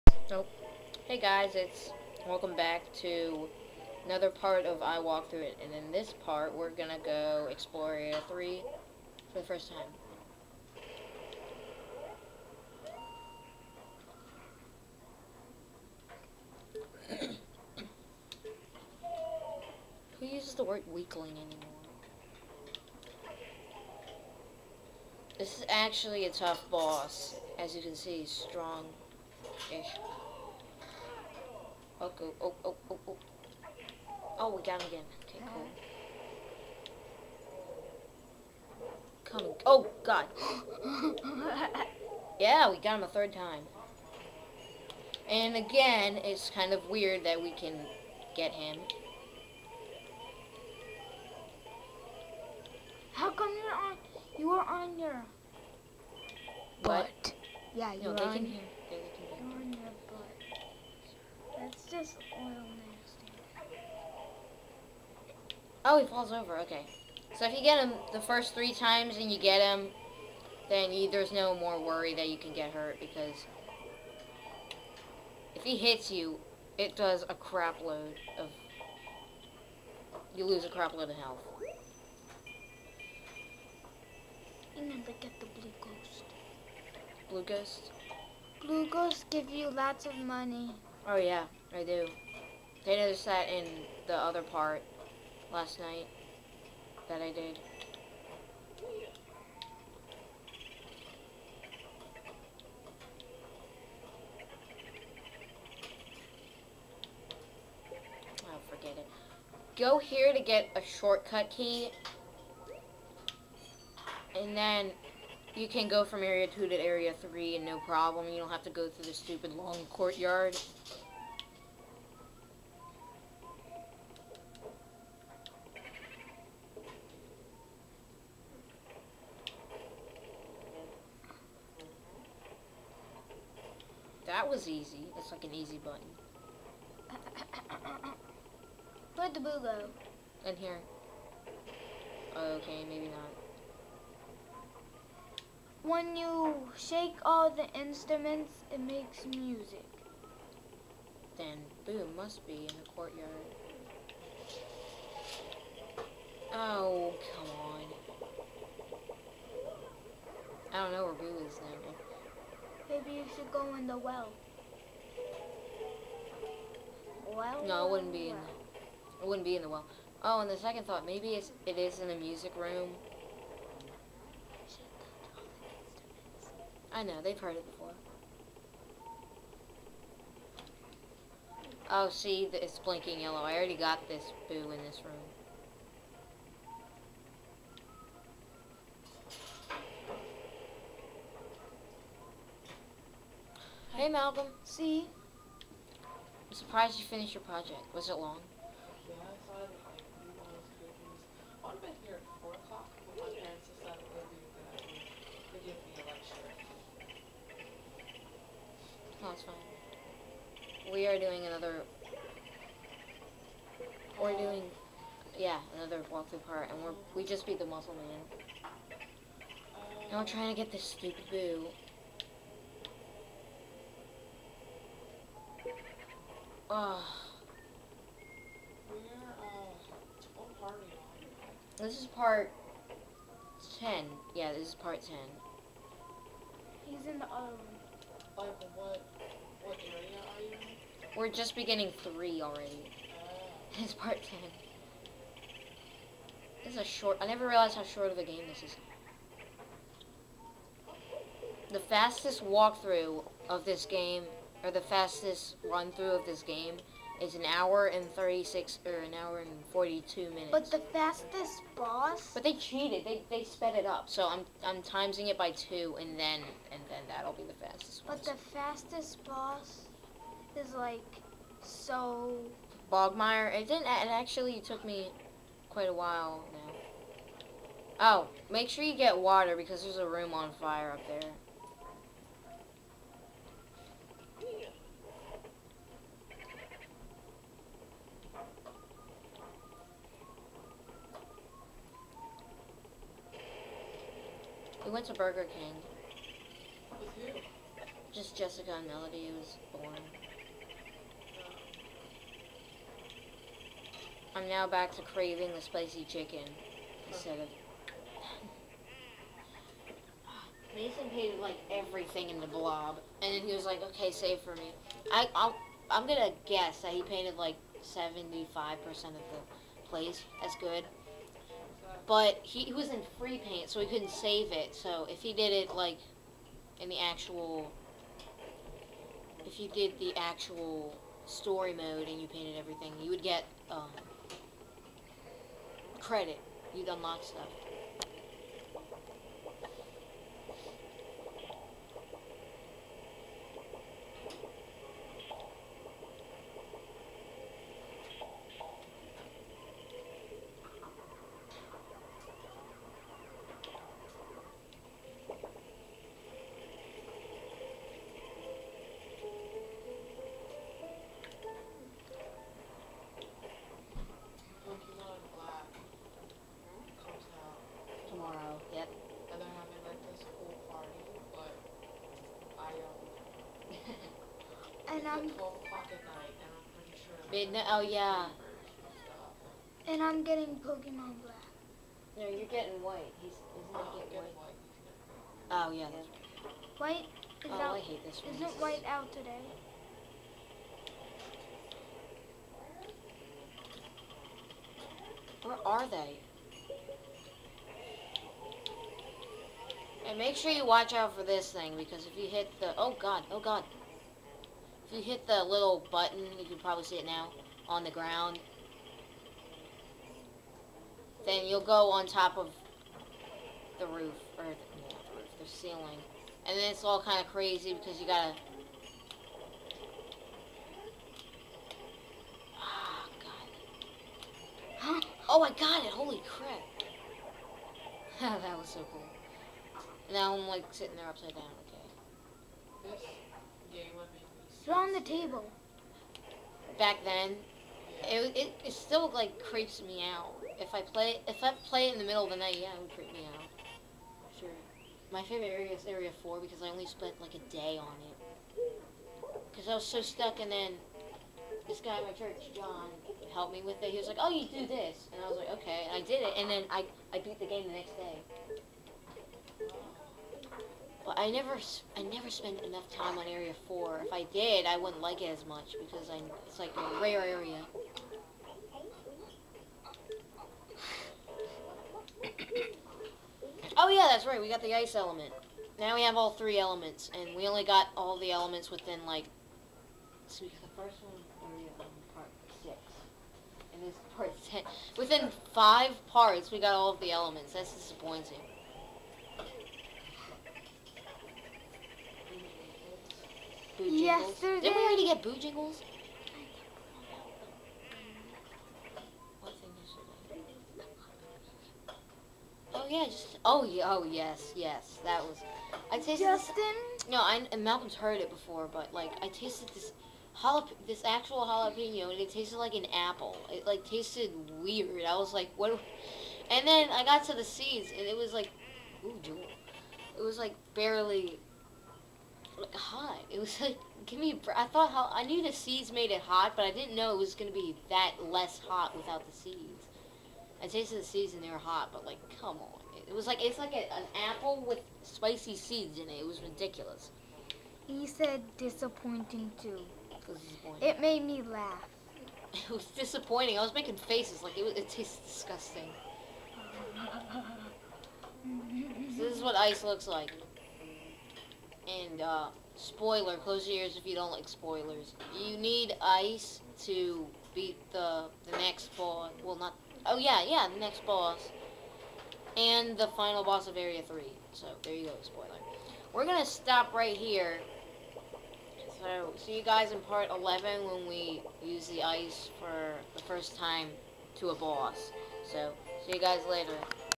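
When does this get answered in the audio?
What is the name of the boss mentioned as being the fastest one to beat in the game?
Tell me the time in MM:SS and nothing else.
04:32.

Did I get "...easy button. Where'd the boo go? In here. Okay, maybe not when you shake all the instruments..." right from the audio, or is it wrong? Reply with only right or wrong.
right.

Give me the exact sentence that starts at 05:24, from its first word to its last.
So if he did it, like, in the actual...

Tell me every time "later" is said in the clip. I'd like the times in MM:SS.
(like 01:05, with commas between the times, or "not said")
09:36.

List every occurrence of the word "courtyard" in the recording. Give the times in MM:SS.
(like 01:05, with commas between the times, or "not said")
01:59, 02:32.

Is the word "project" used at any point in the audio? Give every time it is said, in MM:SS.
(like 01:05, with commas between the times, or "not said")
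03:17.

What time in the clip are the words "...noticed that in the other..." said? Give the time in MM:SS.
01:32.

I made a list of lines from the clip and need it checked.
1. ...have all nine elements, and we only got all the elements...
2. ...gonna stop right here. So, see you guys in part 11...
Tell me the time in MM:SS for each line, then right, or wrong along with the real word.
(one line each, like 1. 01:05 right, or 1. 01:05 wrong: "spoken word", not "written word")
1. 07:56 wrong: "three", not "nine"
2. 09:26 right.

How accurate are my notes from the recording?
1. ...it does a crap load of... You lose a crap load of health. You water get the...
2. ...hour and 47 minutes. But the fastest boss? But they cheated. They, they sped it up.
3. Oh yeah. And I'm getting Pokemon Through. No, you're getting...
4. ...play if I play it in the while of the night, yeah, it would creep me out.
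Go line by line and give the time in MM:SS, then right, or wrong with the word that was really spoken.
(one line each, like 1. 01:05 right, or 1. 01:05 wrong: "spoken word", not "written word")
1. 01:16 wrong: "never", not "water"
2. 04:19 wrong: "42", not "47"
3. 06:17 wrong: "Black", not "Through"
4. 07:20 wrong: "middle", not "while".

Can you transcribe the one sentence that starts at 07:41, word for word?
But I never, I never spend enough time on Area 4.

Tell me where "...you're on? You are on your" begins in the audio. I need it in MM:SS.
00:53.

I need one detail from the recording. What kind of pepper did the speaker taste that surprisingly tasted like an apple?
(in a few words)
Jalapeno.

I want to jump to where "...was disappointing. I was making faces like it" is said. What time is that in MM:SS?
09:02.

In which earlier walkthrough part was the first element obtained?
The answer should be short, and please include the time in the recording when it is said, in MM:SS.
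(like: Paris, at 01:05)
Part 6, at 08:02.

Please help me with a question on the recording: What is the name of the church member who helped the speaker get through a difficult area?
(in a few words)
John.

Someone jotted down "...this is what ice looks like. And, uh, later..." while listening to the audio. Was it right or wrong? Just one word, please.
wrong.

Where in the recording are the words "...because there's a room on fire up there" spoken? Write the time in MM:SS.
04:39.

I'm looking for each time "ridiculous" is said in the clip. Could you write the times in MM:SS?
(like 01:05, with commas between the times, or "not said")
08:56.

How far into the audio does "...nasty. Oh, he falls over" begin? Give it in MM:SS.
01:02.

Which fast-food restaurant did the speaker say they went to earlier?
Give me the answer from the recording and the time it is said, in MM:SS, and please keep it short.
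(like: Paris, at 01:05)
Burger King, at 04:55.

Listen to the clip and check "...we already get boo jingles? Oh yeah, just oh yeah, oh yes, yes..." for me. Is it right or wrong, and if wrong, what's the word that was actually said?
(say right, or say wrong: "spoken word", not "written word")
right.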